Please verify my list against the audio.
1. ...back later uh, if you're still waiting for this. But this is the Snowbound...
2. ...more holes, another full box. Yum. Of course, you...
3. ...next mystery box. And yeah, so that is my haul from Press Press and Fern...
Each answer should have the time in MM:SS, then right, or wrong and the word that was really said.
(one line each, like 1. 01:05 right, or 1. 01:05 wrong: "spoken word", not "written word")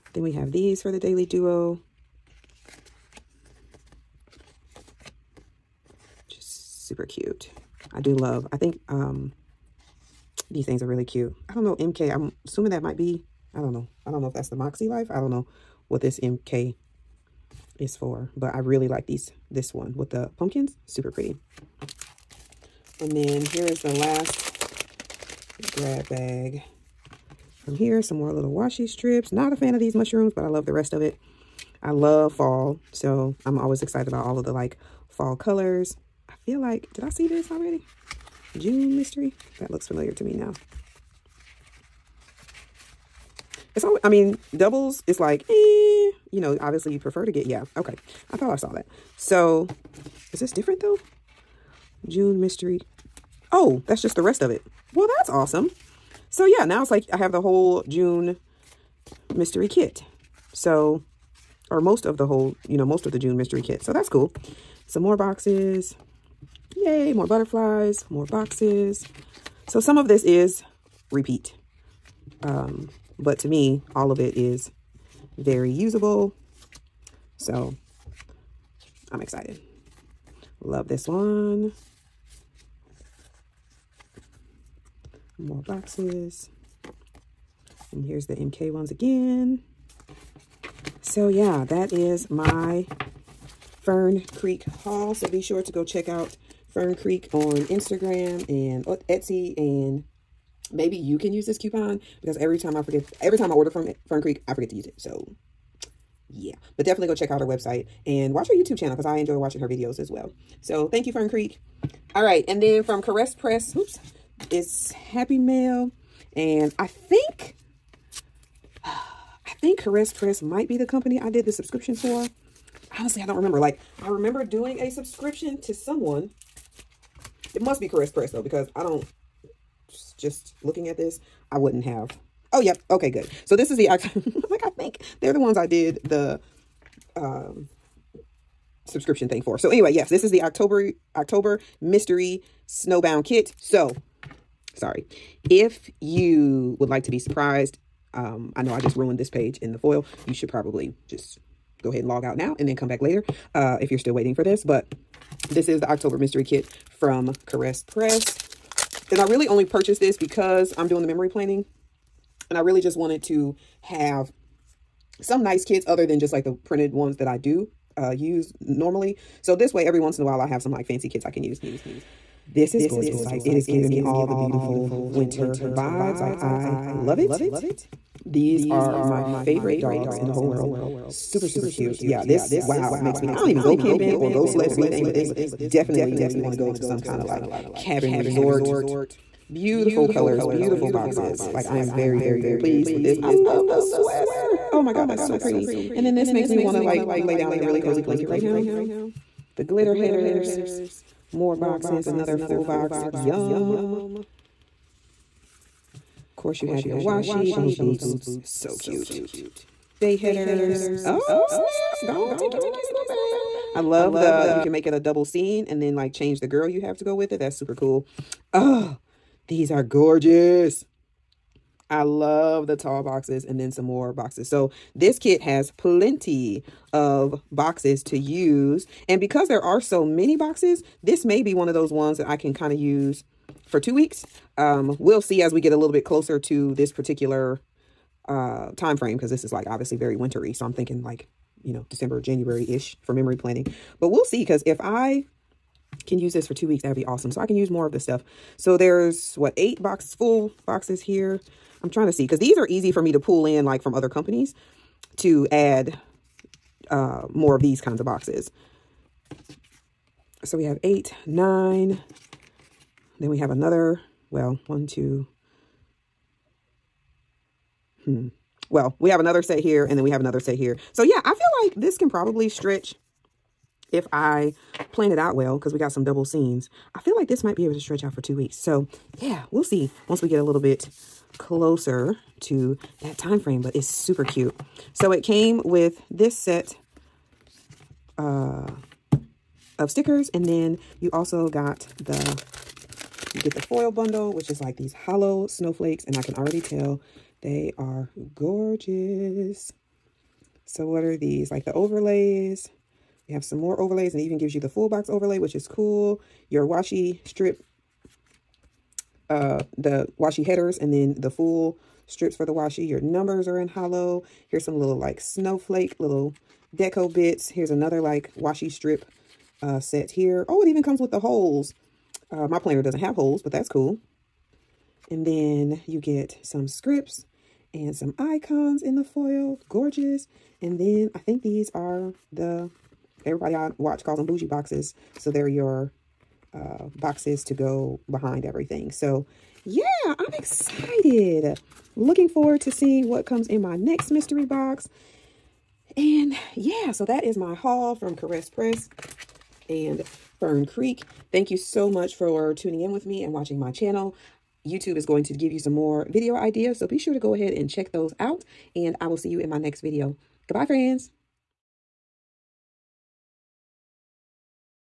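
1. 02:32 wrong: "October", not "Snowbound"
2. 03:21 wrong: "boxes", not "holes"
3. 05:43 wrong: "Caress", not "Press".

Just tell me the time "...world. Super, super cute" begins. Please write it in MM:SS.
03:00.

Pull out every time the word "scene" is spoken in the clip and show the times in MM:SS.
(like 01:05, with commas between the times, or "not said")
03:35.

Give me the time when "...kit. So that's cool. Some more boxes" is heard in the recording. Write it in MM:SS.
01:03.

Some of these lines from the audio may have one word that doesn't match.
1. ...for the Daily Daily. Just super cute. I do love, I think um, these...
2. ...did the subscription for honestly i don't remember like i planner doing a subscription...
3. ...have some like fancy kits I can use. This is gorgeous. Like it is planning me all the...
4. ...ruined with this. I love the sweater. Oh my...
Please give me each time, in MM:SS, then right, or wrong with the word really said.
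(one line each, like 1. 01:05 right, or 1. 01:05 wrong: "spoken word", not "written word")
1. 00:00 wrong: "Duo", not "Daily"
2. 02:01 wrong: "remember", not "planner"
3. 02:50 wrong: "giving", not "planning"
4. 03:12 wrong: "pleased", not "ruined".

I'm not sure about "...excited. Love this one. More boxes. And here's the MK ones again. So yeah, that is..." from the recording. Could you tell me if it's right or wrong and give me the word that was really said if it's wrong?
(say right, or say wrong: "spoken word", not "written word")
right.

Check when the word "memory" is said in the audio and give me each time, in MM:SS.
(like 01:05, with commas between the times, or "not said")
02:41, 04:03.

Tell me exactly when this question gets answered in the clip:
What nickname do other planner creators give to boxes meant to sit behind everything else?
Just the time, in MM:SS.
05:34.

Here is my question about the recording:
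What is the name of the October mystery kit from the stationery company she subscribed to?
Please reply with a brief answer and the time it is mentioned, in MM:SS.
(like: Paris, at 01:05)
Snowbound, at 02:22.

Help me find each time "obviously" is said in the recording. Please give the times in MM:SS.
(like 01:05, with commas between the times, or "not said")
00:46, 03:59.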